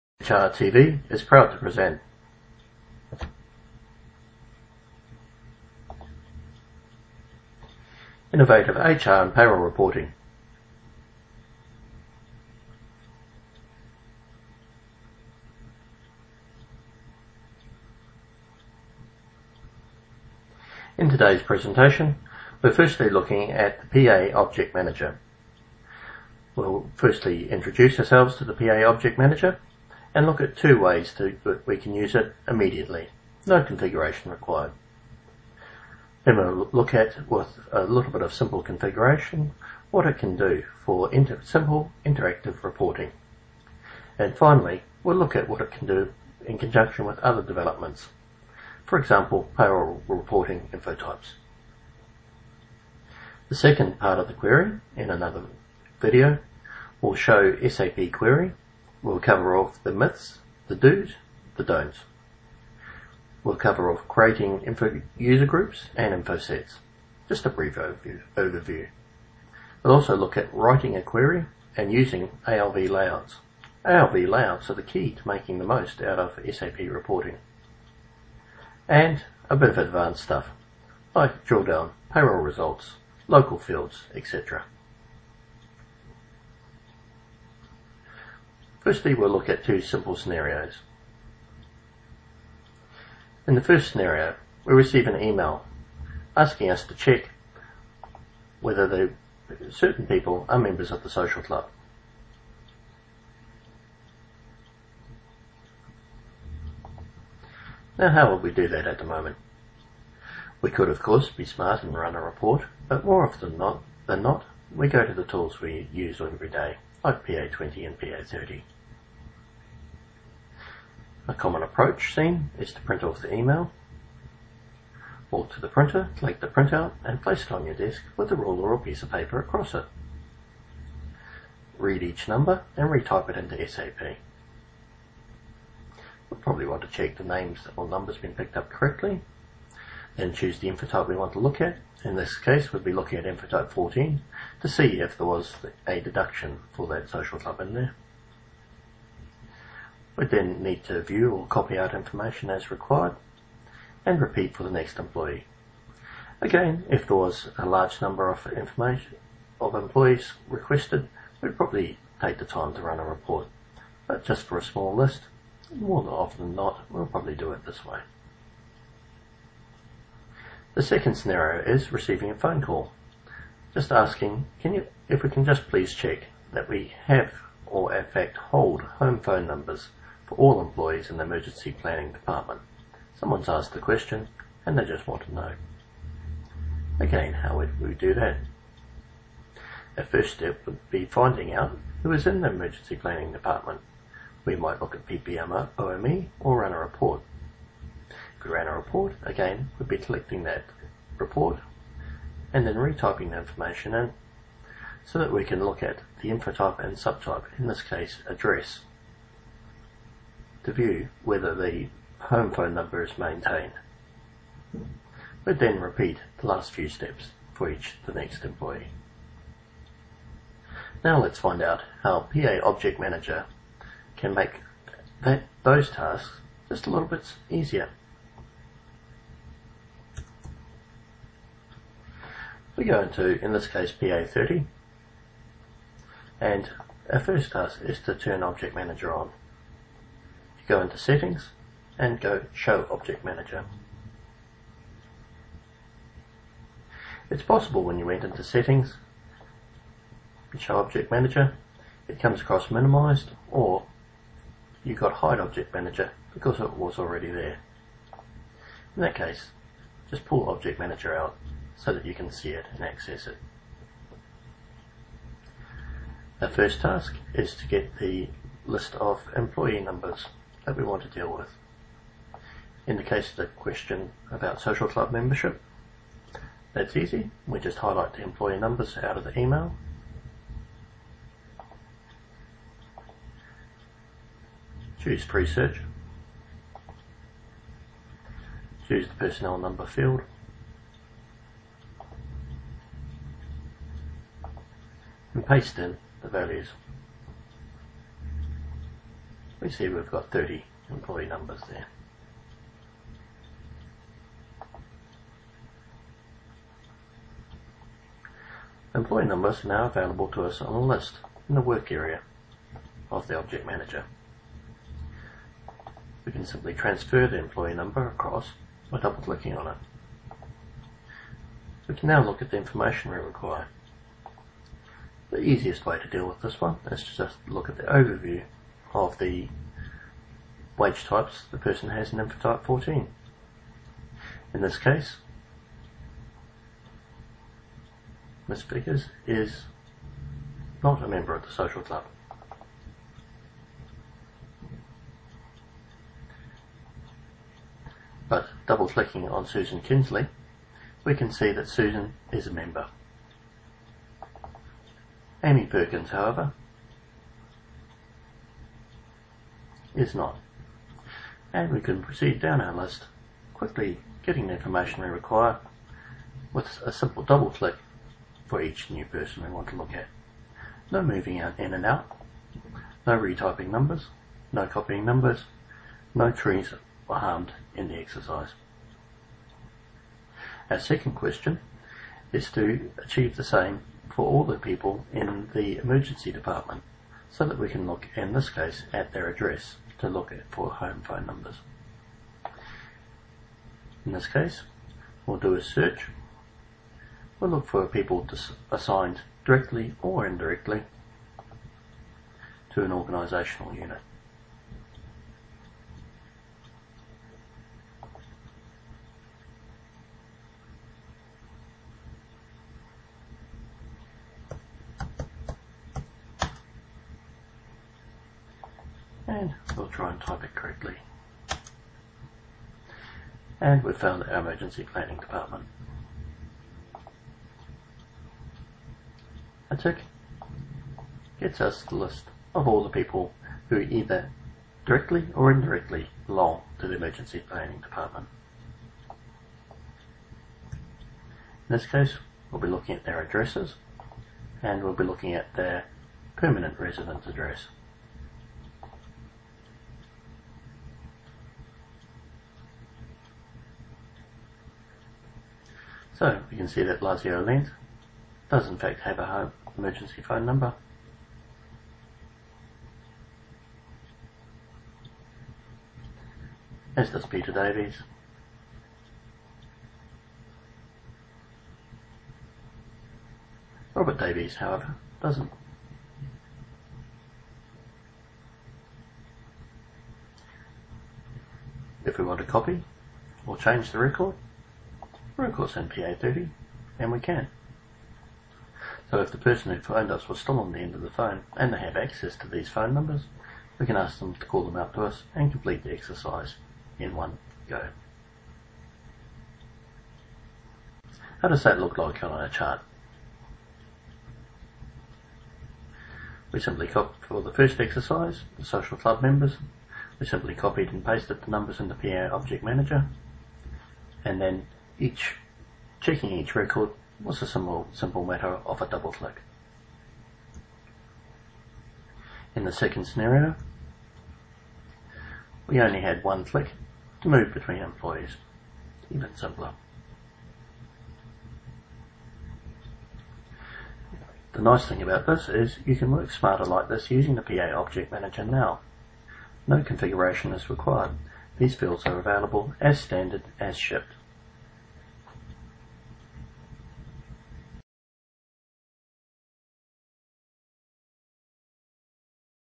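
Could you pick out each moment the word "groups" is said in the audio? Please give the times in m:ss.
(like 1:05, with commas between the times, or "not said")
1:05.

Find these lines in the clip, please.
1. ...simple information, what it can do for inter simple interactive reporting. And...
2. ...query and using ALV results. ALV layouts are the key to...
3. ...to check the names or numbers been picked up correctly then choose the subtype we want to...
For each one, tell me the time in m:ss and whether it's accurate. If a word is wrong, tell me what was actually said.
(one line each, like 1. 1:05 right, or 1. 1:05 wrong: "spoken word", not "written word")
1. 0:38 wrong: "configuration", not "information"
2. 1:11 wrong: "layouts", not "results"
3. 2:16 wrong: "infotype", not "subtype".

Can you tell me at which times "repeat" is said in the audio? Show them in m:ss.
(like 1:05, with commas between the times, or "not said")
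2:34, 3:35.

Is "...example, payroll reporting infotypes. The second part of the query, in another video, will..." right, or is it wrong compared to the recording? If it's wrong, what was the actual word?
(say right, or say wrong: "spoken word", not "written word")
right.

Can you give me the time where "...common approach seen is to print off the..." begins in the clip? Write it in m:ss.
2:01.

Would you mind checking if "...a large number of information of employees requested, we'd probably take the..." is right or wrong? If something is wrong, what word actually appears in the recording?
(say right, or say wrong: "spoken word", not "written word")
right.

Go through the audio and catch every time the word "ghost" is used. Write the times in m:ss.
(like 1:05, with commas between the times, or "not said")
not said.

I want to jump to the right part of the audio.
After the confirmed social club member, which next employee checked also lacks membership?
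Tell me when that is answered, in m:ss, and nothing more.
5:55.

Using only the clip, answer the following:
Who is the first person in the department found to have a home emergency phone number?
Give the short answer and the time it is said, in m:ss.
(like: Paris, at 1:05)
Lazio Lent, at 7:36.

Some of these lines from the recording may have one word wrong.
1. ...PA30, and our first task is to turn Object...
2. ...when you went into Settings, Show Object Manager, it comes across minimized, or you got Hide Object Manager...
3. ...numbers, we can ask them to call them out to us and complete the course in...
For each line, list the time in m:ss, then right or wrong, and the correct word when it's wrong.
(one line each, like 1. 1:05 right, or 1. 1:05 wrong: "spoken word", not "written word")
1. 3:54 right
2. 4:07 right
3. 8:12 wrong: "exercise", not "course".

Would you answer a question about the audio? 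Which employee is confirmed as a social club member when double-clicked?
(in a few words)
Susan Kinsley.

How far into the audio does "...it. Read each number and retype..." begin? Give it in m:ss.
2:09.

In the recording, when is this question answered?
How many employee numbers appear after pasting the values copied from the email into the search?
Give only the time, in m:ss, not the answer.
5:00.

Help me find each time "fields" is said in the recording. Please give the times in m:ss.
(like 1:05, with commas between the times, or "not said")
1:23, 4:49, 9:01.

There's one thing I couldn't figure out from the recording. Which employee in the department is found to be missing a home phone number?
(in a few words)
Robert Davies.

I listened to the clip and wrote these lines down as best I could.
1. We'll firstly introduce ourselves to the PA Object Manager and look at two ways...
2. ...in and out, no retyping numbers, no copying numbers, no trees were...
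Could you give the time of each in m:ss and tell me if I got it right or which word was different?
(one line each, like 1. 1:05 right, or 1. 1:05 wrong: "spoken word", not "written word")
1. 0:26 right
2. 6:11 right.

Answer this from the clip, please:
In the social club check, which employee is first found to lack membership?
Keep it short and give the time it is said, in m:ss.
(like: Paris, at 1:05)
Ms. Vickers, at 5:38.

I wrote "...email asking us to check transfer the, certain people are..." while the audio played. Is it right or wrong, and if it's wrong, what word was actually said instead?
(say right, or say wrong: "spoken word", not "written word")
wrong: "whether", not "transfer".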